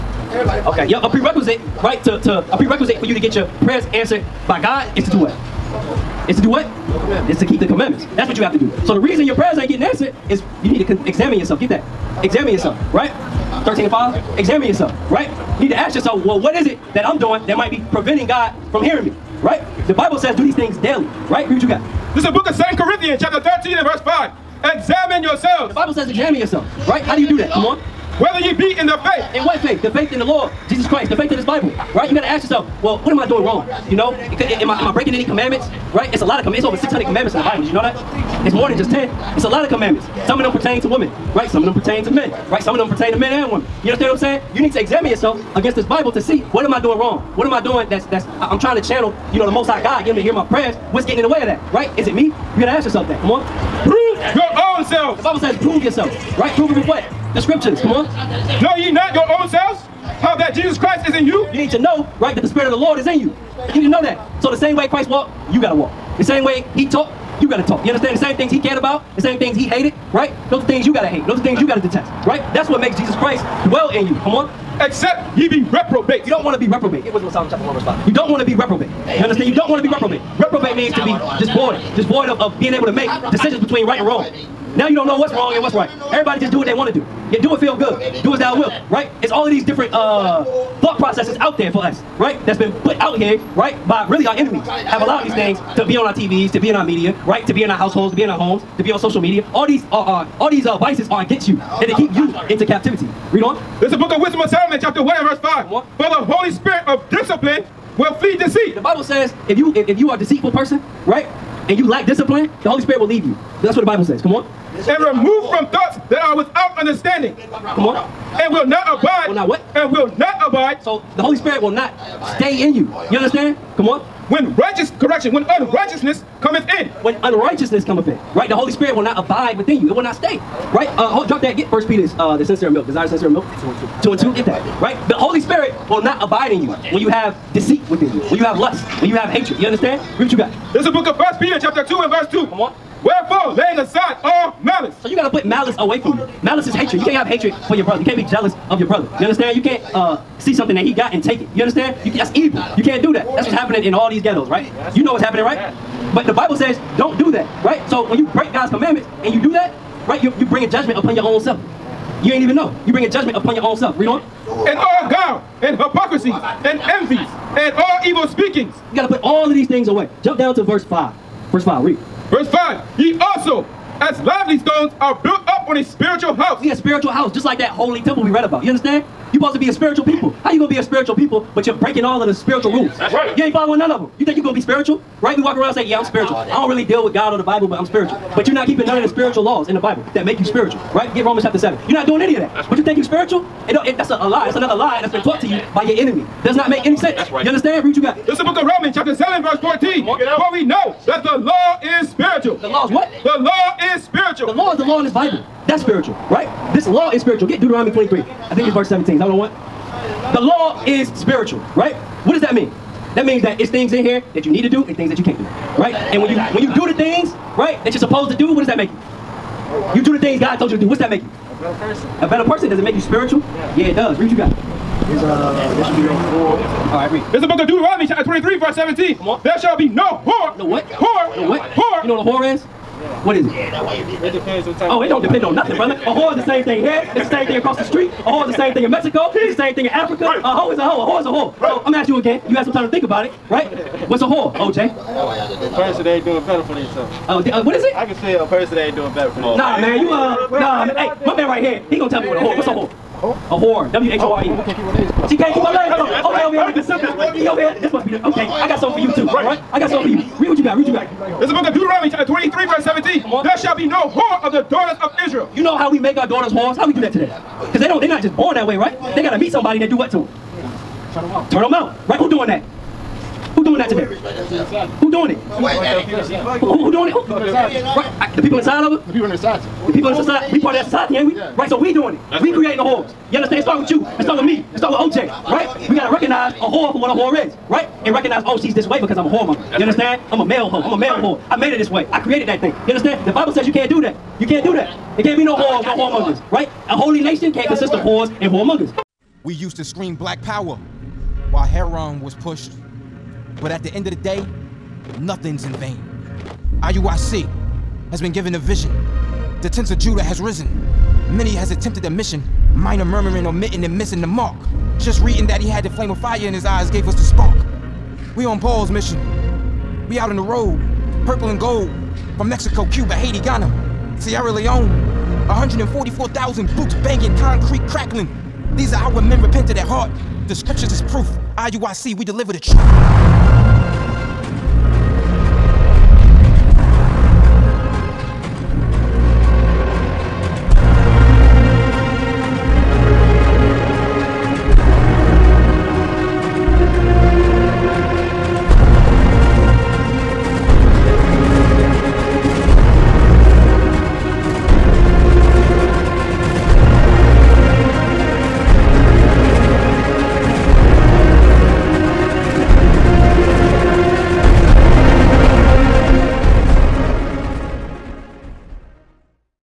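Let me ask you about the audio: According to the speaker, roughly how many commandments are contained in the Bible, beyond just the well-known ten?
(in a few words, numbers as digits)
over 600.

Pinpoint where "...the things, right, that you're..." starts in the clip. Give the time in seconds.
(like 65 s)
216 s.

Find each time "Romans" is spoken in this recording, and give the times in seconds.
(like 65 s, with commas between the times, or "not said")
191 s, 198 s.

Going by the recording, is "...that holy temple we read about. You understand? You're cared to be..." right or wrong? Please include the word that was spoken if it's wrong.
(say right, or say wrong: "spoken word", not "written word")
wrong: "supposed", not "cared".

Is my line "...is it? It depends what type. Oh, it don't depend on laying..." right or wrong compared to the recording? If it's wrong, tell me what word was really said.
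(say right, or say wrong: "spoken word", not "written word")
wrong: "nothing", not "laying".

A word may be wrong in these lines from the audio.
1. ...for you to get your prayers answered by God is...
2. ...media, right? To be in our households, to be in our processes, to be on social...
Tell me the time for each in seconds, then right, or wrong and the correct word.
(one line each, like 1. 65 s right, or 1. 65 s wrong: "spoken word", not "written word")
1. 3 s right
2. 96 s wrong: "homes", not "processes".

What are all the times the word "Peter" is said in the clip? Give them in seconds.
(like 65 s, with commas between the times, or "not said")
131 s, 141 s.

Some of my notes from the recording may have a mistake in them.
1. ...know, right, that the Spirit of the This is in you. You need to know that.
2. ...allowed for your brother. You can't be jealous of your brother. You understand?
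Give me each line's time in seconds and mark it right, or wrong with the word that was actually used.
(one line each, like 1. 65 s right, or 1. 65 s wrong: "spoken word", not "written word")
1. 61 s wrong: "Lord", not "This"
2. 147 s wrong: "hatred", not "allowed".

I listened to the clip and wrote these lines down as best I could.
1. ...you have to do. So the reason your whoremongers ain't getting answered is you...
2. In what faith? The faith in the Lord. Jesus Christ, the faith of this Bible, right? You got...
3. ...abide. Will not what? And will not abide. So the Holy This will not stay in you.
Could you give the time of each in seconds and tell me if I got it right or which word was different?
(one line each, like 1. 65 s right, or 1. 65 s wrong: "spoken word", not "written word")
1. 8 s wrong: "prayers", not "whoremongers"
2. 29 s right
3. 118 s wrong: "Spirit", not "This".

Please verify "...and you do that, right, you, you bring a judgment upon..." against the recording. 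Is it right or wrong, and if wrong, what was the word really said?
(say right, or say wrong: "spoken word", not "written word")
right.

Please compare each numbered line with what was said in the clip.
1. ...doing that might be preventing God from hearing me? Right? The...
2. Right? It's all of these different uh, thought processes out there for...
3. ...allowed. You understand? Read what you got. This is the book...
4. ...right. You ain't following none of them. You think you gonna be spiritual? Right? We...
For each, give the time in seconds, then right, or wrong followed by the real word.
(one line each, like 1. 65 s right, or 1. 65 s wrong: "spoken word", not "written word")
1. 17 s right
2. 88 s right
3. 139 s wrong: "hatred", not "allowed"
4. 183 s right.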